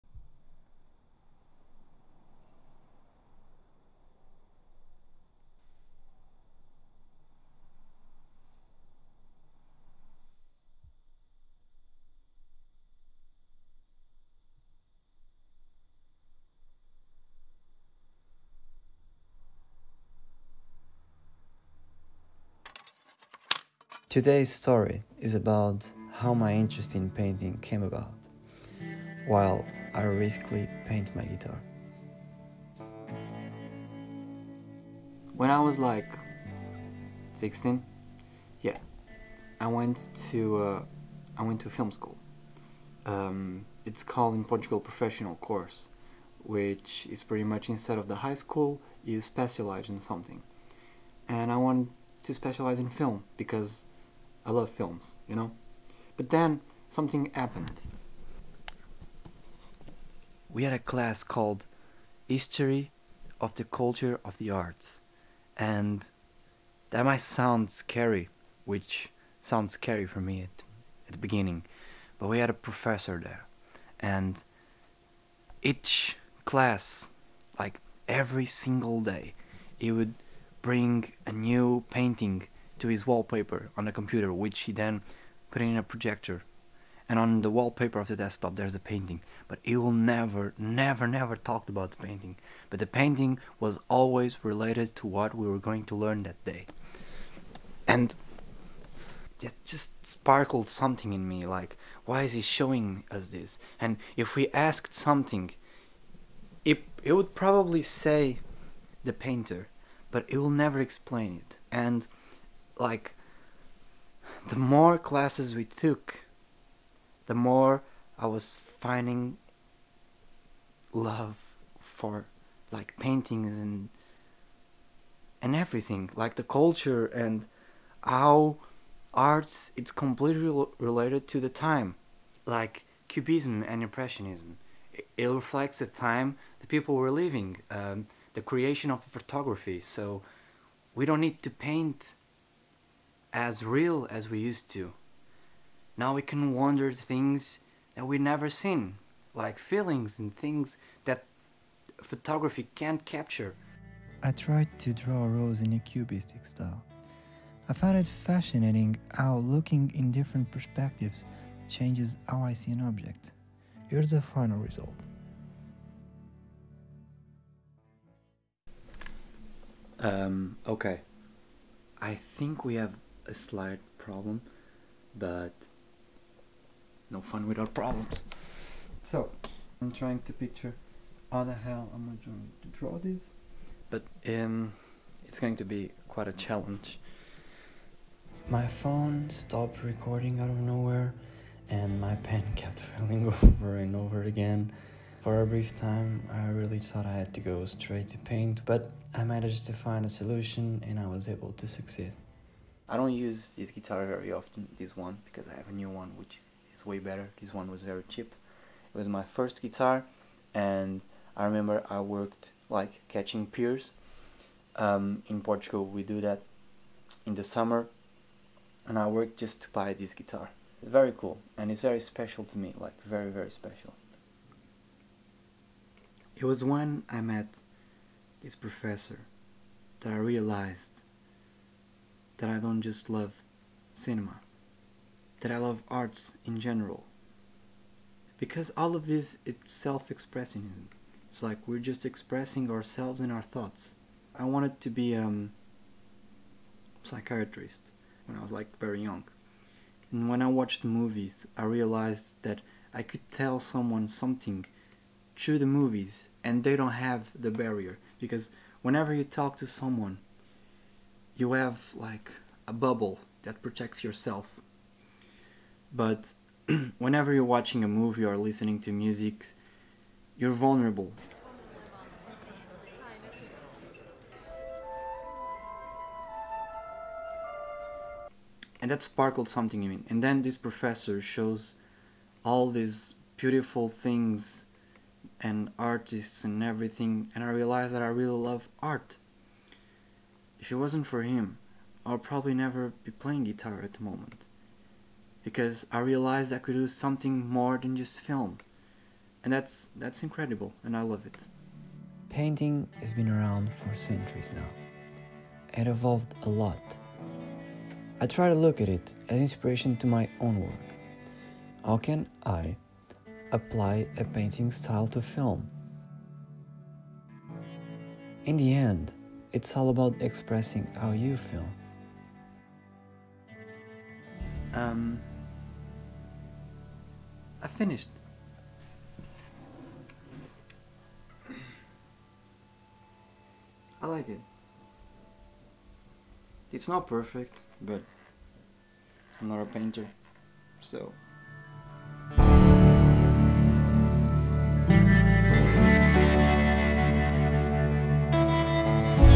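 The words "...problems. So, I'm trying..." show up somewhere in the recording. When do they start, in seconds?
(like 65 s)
177 s.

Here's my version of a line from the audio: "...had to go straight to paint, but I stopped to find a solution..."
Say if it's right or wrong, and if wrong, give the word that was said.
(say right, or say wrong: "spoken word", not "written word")
wrong: "managed", not "stopped".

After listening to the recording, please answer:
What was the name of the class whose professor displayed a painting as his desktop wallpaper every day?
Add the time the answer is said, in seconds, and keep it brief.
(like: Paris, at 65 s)
History of the Culture of the Arts, at 62 s.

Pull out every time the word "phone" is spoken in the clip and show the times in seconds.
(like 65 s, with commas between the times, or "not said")
188 s.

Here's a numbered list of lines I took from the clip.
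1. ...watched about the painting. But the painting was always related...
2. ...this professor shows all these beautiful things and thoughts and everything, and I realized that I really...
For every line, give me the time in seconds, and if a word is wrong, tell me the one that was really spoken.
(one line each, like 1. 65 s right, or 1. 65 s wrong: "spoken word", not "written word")
1. 91 s wrong: "talked", not "watched"
2. 280 s wrong: "artists", not "thoughts".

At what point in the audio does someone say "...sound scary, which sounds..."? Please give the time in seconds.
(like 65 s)
67 s.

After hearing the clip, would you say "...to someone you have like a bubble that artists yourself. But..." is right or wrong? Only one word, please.
wrong.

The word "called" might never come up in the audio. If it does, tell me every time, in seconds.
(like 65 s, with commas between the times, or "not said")
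44 s, 61 s.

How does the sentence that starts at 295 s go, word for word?
Because I realized I could do something more than just film.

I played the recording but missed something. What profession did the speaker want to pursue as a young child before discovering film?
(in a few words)
psychiatrist.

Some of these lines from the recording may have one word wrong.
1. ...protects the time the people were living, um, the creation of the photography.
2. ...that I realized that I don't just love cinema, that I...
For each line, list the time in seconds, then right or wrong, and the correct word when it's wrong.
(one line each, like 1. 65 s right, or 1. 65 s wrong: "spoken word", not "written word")
1. 135 s wrong: "reflects", not "protects"
2. 230 s right.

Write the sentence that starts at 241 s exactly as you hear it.
It's like we're just expressing ourselves and our thoughts.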